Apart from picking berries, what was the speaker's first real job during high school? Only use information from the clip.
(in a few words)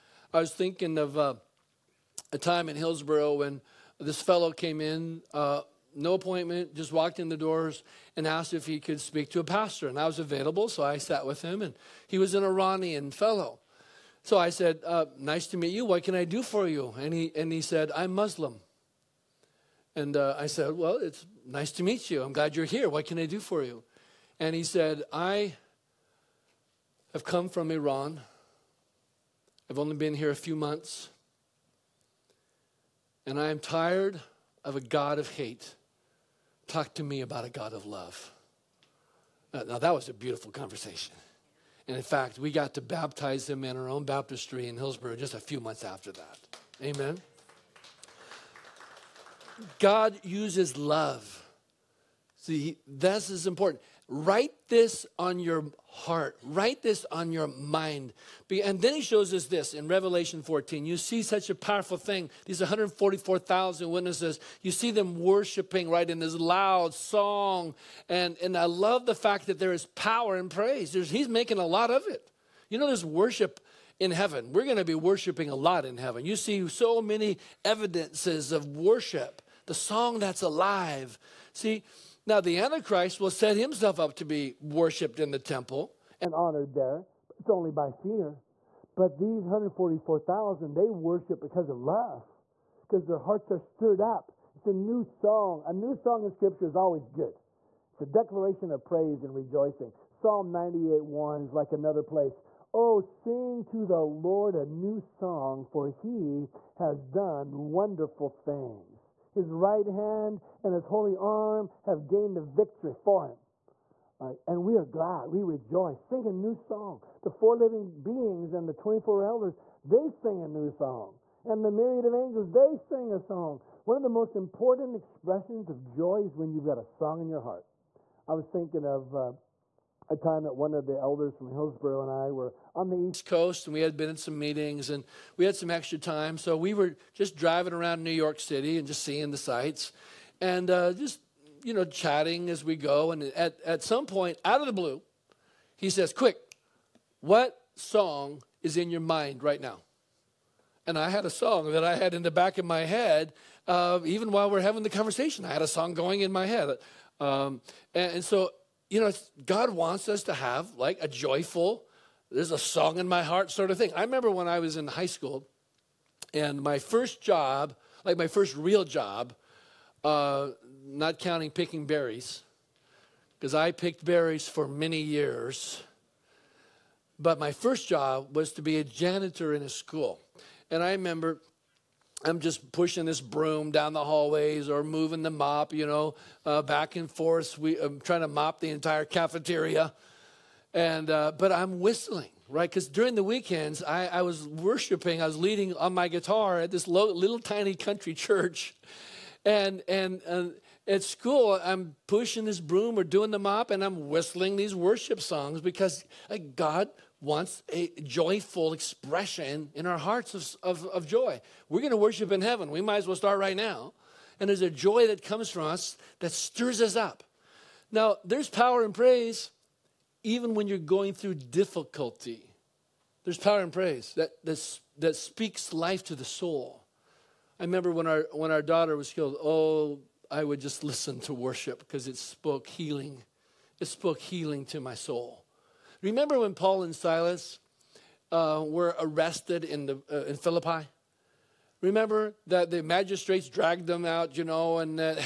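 Janitor.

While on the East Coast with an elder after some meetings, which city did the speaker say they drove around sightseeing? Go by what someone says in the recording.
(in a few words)
New York City.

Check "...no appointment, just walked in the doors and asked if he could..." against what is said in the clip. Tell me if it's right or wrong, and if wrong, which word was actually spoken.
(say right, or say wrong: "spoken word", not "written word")
right.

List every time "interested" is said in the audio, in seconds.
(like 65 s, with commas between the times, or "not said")
not said.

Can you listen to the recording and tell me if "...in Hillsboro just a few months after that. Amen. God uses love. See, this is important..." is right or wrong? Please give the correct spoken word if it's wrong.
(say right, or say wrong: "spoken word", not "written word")
right.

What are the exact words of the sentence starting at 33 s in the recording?
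And I am tired of a God of hate.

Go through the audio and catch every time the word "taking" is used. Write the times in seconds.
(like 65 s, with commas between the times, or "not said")
not said.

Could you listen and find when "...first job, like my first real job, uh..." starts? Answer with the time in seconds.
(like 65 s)
166 s.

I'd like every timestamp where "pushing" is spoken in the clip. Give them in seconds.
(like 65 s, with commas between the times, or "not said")
182 s, 202 s.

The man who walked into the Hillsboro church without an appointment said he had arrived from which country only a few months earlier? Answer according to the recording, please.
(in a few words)
Iran.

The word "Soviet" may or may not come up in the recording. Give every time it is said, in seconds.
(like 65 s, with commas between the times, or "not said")
not said.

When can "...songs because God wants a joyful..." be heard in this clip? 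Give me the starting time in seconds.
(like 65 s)
205 s.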